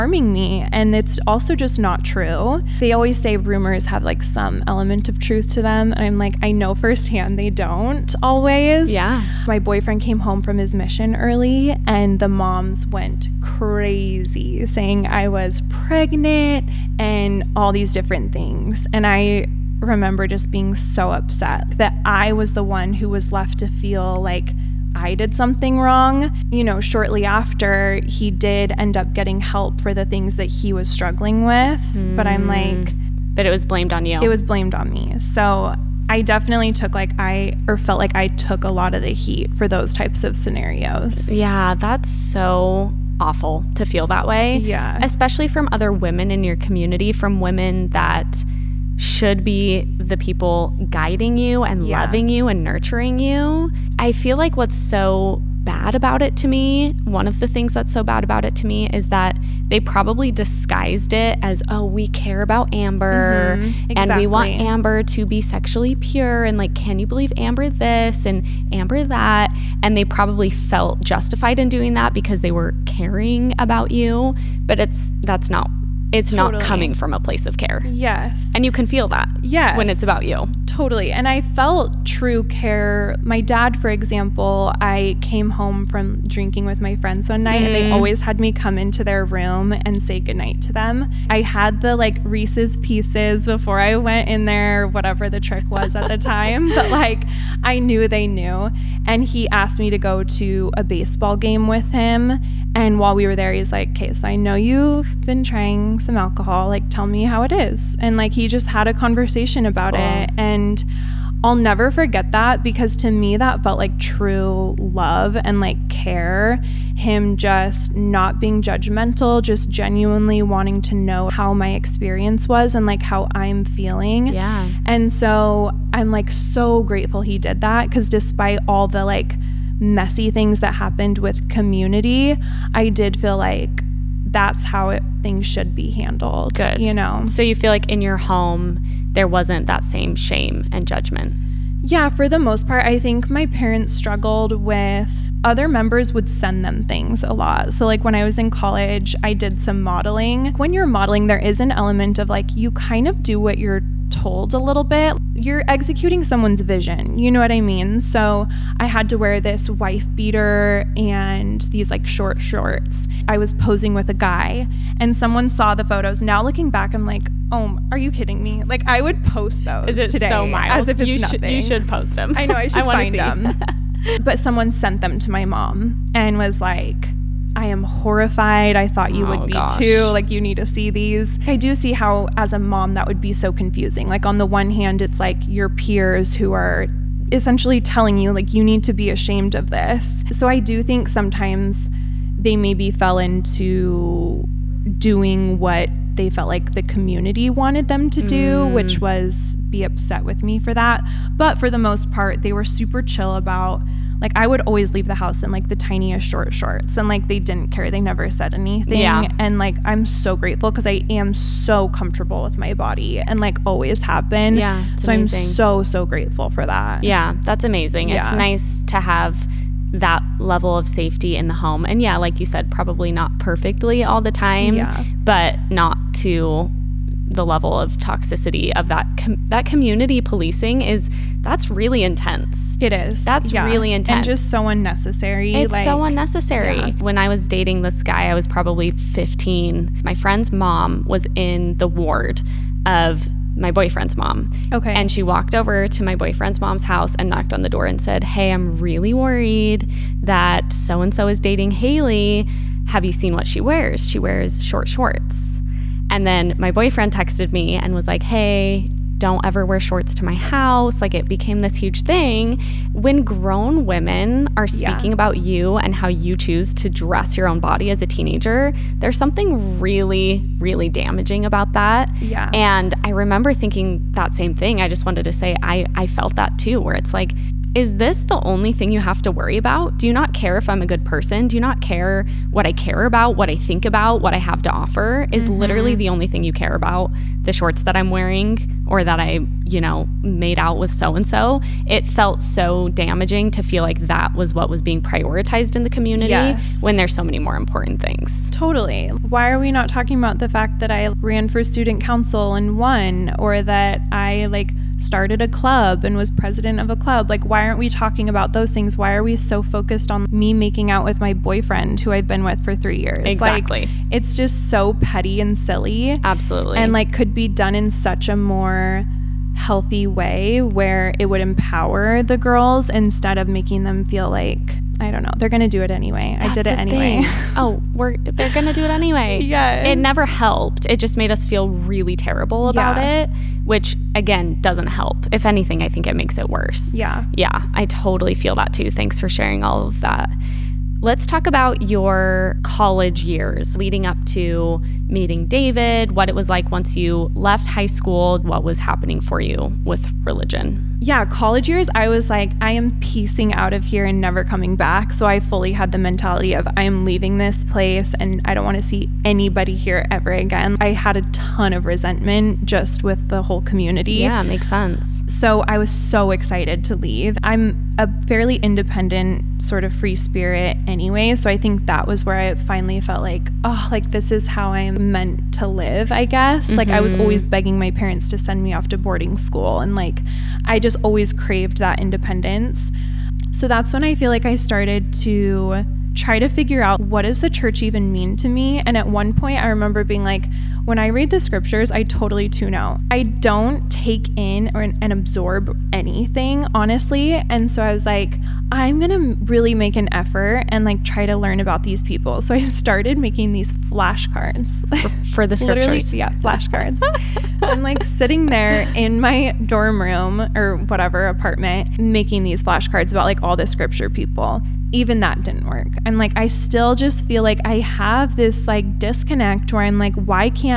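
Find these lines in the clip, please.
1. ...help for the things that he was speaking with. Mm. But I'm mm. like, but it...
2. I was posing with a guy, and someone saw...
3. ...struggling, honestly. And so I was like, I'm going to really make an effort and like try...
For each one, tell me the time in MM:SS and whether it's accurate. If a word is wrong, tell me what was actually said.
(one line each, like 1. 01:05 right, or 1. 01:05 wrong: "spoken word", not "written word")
1. 00:29 wrong: "struggling", not "speaking"
2. 02:43 right
3. 06:35 wrong: "anything", not "struggling".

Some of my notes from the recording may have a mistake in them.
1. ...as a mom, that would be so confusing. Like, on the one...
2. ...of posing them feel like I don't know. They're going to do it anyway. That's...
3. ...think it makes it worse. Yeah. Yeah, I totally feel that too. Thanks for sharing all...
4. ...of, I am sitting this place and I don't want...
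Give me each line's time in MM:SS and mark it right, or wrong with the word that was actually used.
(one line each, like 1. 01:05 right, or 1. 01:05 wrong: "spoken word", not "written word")
1. 03:02 right
2. 05:23 wrong: "making", not "posing"
3. 05:35 right
4. 05:56 wrong: "leaving", not "sitting".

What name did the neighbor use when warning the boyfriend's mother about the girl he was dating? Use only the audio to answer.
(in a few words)
Hayley.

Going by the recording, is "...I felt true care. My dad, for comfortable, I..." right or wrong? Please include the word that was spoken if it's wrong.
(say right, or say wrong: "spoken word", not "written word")
wrong: "example", not "comfortable".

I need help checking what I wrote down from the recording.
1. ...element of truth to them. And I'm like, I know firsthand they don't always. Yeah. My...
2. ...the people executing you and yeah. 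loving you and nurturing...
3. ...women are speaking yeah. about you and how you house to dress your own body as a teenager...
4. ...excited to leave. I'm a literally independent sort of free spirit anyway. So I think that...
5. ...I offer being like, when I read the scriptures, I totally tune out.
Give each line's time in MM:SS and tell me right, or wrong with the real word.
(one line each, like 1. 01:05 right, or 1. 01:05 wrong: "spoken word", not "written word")
1. 00:04 right
2. 00:49 wrong: "guiding", not "executing"
3. 04:23 wrong: "choose", not "house"
4. 06:06 wrong: "fairly", not "literally"
5. 06:29 wrong: "remember", not "offer".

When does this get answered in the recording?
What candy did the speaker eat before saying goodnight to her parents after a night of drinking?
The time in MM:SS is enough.
01:32.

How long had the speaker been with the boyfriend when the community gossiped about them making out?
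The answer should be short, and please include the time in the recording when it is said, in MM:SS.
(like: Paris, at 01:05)
3 years, at 05:12.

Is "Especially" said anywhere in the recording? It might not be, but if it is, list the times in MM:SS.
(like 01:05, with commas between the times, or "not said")
00:45.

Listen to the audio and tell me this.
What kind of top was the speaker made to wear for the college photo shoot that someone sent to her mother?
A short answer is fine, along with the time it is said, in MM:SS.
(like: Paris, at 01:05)
wife beater, at 02:39.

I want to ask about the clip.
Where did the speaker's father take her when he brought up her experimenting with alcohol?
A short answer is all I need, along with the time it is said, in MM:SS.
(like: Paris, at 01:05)
a baseball game, at 01:40.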